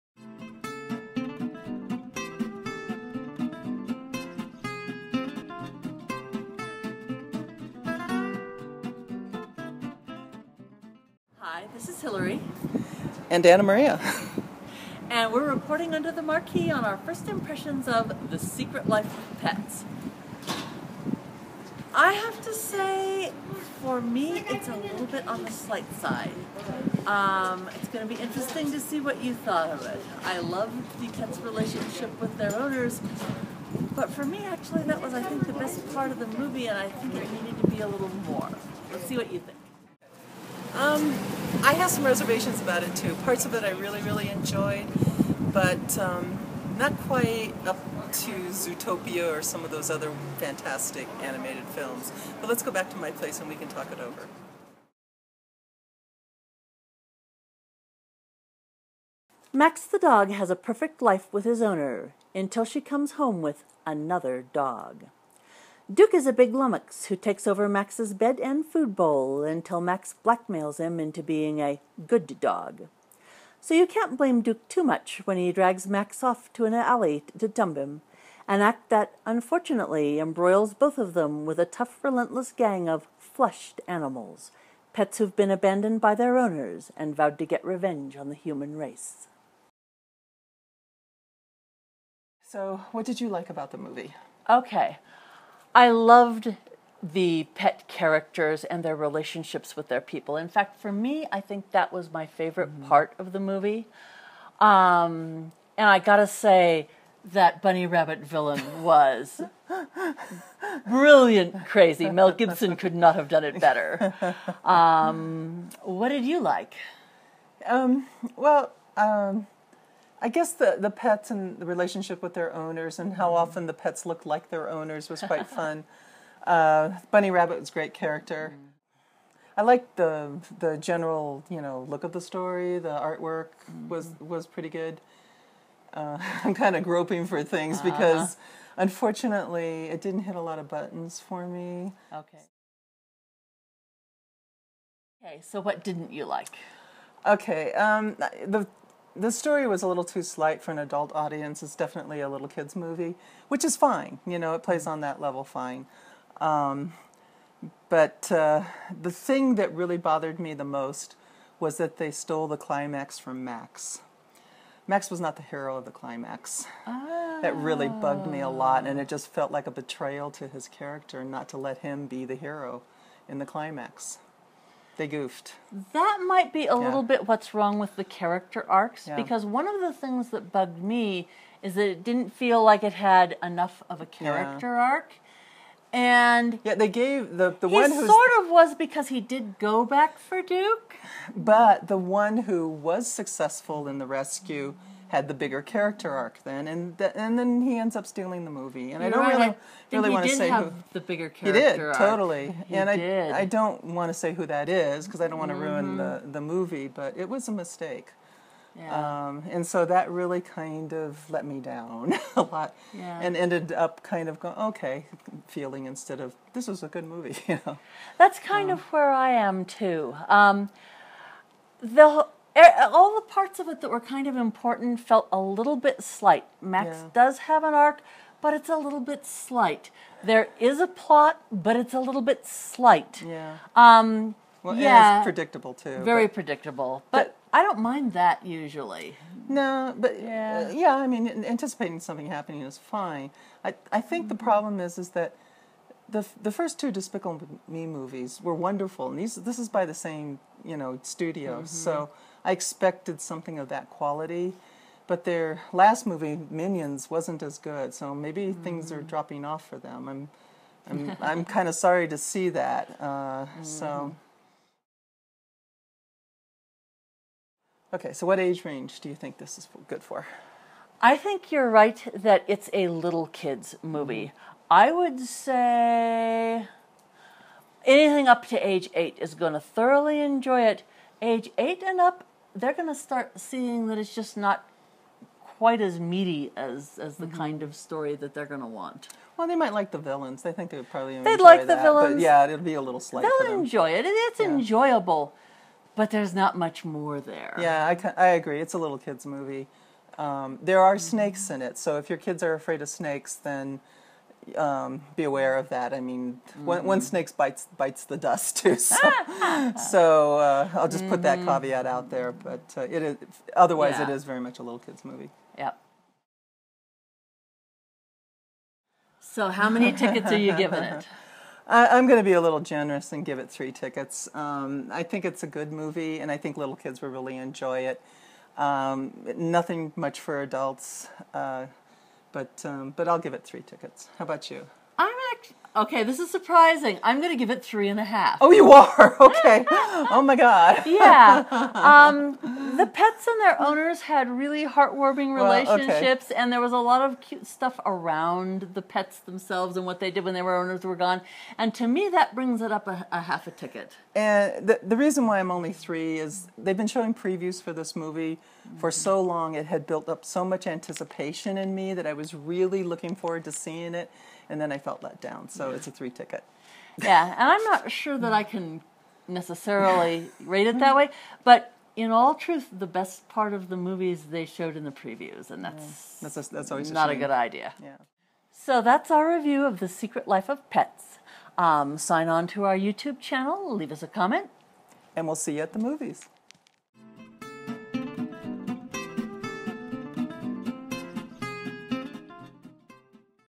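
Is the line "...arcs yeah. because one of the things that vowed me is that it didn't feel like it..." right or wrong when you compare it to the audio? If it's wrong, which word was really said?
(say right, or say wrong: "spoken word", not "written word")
wrong: "bugged", not "vowed".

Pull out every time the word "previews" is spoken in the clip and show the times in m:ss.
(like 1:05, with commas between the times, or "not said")
5:57, 6:14.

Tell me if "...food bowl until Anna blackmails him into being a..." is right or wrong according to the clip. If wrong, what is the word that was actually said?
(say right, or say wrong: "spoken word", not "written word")
wrong: "Max", not "Anna".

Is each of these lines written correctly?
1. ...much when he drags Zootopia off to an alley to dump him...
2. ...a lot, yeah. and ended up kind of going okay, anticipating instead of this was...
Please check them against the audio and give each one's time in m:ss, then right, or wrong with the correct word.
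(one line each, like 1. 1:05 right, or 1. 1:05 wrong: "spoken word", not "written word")
1. 1:14 wrong: "Max", not "Zootopia"
2. 3:32 wrong: "feeling", not "anticipating".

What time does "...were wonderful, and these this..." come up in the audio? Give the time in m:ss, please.
4:08.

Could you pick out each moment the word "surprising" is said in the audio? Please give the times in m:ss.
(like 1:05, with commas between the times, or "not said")
5:36.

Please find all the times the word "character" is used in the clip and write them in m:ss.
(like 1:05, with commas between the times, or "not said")
1:37, 2:07, 2:50, 2:58, 3:04, 3:15, 3:21.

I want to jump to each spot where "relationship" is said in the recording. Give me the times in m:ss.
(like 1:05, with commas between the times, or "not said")
0:31, 1:38, 2:01, 5:45.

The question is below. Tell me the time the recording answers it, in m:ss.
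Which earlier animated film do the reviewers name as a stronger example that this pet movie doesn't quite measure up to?
0:48.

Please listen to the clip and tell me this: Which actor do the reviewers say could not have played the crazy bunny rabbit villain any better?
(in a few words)
Mel Gibson.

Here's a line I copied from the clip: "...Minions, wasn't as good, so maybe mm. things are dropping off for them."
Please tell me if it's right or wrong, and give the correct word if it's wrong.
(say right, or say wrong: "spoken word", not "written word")
right.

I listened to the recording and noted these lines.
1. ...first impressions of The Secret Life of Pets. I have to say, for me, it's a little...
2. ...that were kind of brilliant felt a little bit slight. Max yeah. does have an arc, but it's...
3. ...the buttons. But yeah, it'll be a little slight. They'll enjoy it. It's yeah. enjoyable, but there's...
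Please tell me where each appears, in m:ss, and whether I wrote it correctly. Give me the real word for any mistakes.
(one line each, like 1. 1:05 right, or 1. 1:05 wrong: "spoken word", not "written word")
1. 0:16 right
2. 3:43 wrong: "important", not "brilliant"
3. 4:51 wrong: "villains", not "buttons".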